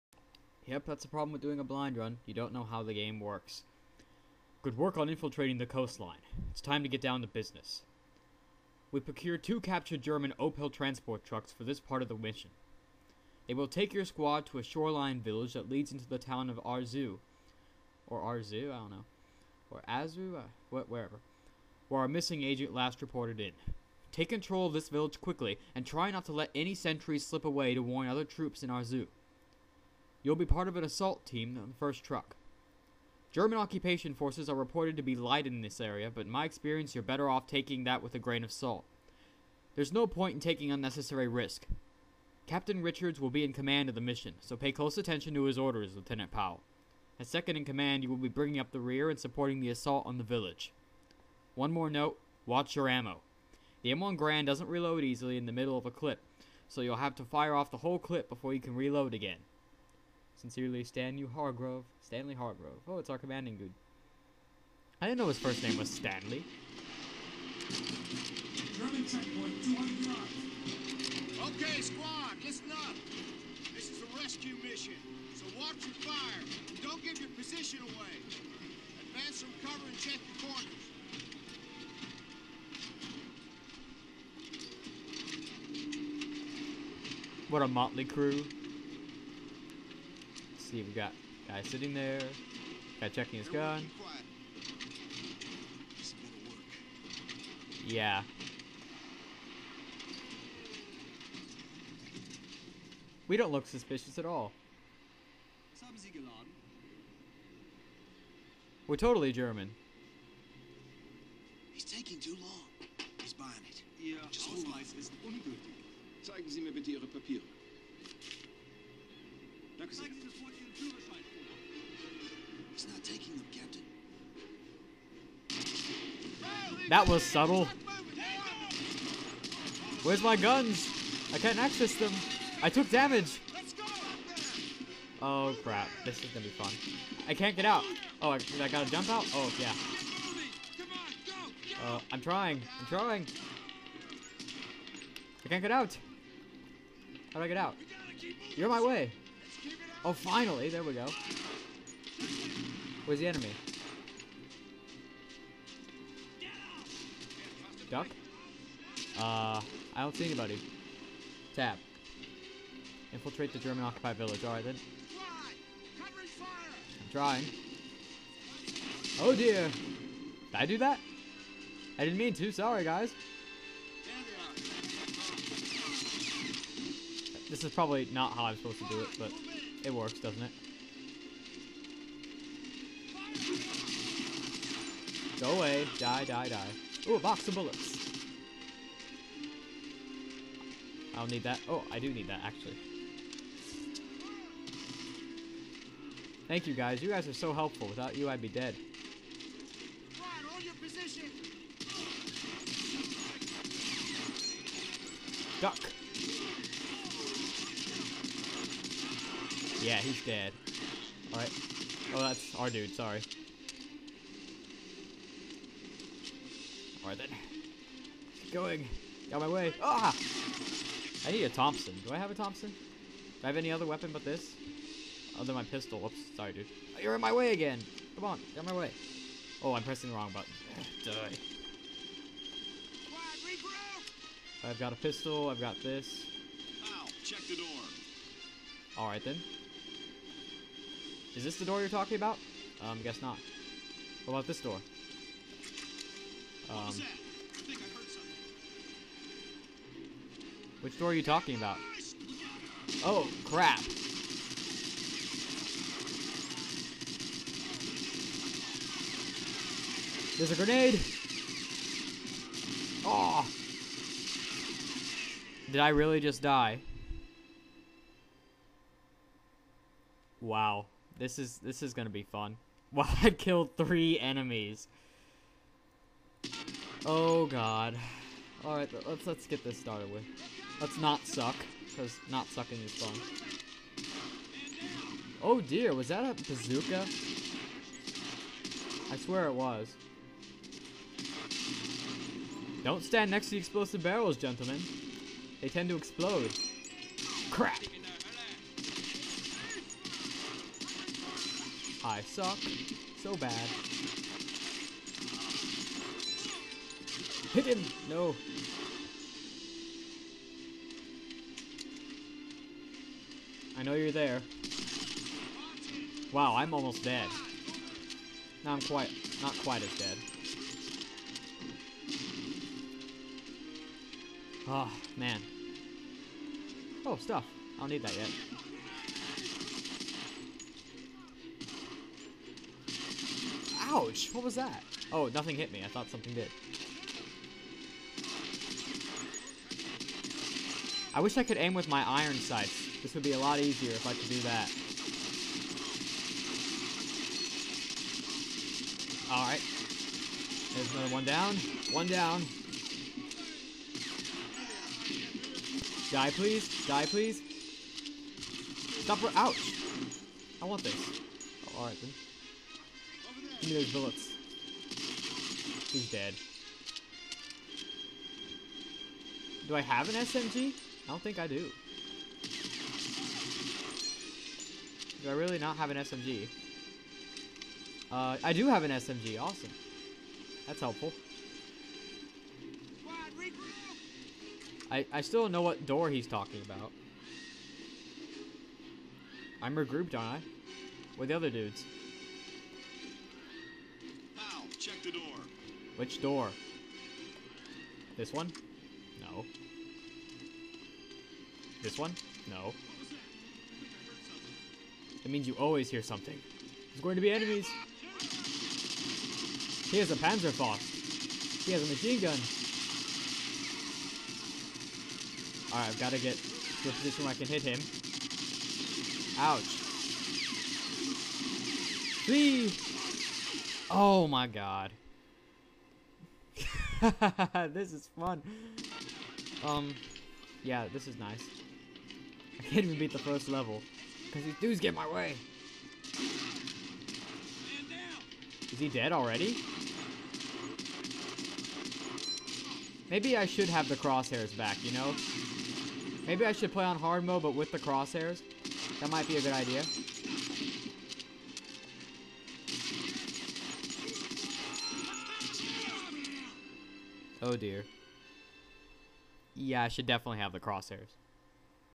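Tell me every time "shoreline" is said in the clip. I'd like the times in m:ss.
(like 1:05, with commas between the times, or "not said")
0:14.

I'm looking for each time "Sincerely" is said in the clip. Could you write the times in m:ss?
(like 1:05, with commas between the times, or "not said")
1:00.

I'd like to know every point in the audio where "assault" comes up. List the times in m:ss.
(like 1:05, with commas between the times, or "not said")
0:30, 0:49.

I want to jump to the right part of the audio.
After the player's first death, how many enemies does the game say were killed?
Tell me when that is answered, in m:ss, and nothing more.
4:33.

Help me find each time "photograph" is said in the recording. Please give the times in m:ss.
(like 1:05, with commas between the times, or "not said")
not said.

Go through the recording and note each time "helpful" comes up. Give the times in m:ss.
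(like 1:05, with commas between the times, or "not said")
3:17, 6:20.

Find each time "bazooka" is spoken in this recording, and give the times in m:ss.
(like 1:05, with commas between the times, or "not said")
4:46.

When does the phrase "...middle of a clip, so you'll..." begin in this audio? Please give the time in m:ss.
0:55.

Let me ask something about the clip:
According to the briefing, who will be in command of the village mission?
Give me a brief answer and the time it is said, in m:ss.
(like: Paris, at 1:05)
Captain Richards, at 0:42.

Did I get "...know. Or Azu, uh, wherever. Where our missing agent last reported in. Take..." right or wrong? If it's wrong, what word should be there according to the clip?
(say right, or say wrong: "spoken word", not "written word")
right.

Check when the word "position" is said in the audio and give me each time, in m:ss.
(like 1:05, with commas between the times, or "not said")
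1:17, 6:56.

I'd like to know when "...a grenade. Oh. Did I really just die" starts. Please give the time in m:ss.
4:20.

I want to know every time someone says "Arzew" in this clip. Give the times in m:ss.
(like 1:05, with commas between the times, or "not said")
0:16, 0:28.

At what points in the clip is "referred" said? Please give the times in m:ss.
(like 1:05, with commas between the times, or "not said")
not said.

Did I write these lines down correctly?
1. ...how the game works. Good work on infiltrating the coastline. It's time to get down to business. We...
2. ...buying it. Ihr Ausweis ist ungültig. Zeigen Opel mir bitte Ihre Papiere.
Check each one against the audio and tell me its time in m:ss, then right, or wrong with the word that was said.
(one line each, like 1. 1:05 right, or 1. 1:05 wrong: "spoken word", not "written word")
1. 0:02 right
2. 1:53 wrong: "Sie", not "Opel".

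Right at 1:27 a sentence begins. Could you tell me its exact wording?
What a motley crew see, we got guy sitting there, guy checking his gun.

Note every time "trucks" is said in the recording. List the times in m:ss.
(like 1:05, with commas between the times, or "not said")
0:11, 0:32.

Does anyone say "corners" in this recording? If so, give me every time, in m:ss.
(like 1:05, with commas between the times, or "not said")
1:20.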